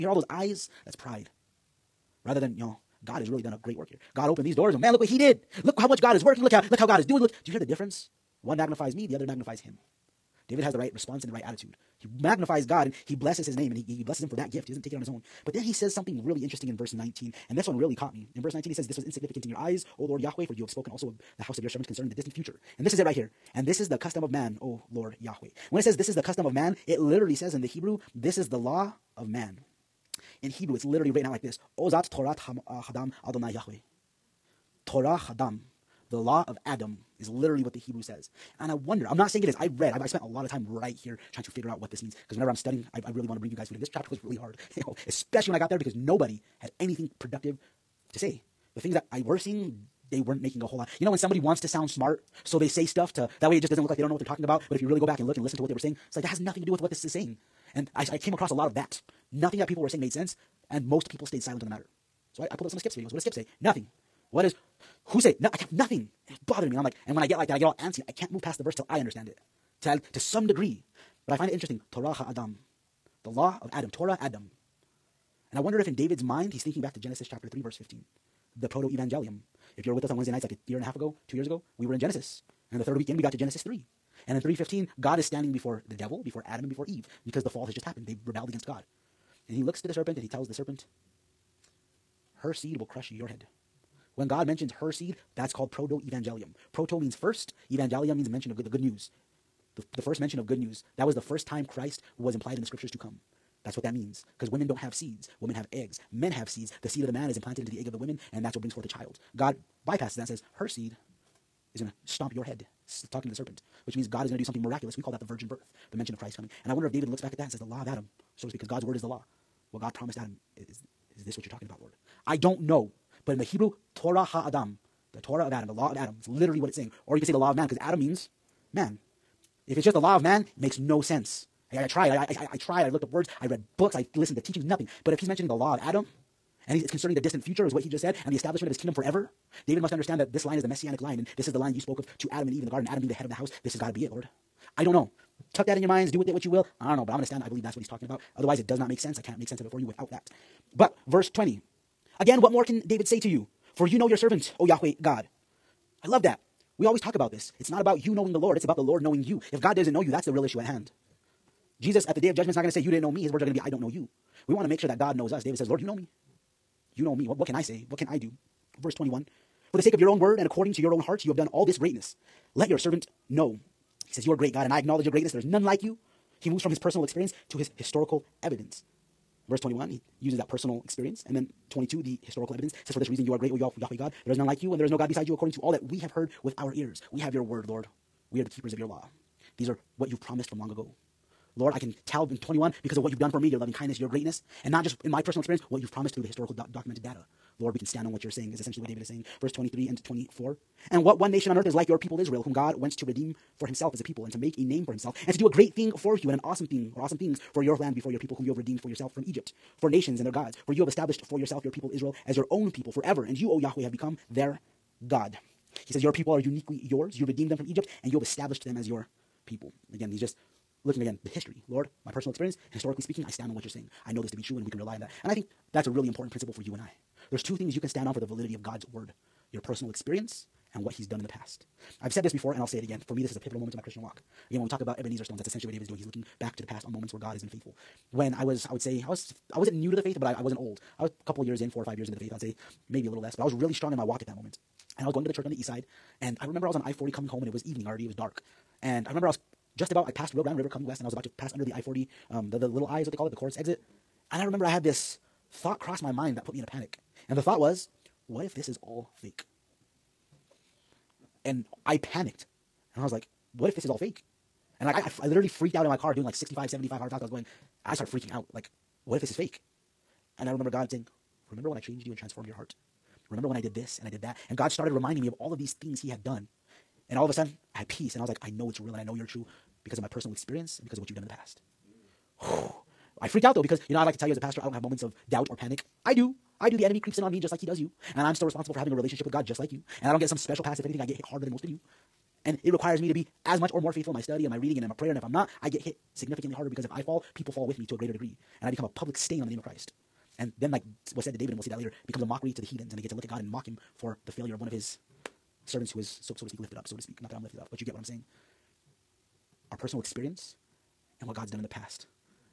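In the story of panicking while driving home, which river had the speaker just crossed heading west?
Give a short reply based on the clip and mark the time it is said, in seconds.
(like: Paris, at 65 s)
Rio Grande, at 250 s.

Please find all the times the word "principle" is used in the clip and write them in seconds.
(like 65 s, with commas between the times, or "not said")
226 s.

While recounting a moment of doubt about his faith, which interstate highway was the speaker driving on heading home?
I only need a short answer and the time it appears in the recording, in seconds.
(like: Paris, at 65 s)
I-40, at 246 s.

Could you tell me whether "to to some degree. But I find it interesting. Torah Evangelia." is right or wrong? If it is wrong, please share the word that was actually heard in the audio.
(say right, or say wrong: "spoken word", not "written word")
wrong: "Adam", not "Evangelia".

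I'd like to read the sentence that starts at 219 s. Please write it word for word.
Again, he's just looking again the history.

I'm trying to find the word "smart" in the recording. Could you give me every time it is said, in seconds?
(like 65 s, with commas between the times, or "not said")
51 s.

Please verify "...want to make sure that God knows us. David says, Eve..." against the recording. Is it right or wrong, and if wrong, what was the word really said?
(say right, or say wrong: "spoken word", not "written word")
wrong: "Lord", not "Eve".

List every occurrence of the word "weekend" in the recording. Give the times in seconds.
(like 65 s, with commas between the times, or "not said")
82 s.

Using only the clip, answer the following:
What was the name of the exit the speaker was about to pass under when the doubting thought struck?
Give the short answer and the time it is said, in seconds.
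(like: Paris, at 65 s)
Coors exit, at 253 s.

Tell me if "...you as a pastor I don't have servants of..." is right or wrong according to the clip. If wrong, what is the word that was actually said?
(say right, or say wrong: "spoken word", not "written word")
wrong: "moments", not "servants".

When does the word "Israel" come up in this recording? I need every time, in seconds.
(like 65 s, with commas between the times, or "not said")
202 s, 211 s.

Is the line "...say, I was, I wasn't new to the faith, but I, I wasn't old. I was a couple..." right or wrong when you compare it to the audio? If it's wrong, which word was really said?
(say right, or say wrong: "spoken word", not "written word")
right.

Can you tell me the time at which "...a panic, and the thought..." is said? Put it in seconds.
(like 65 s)
256 s.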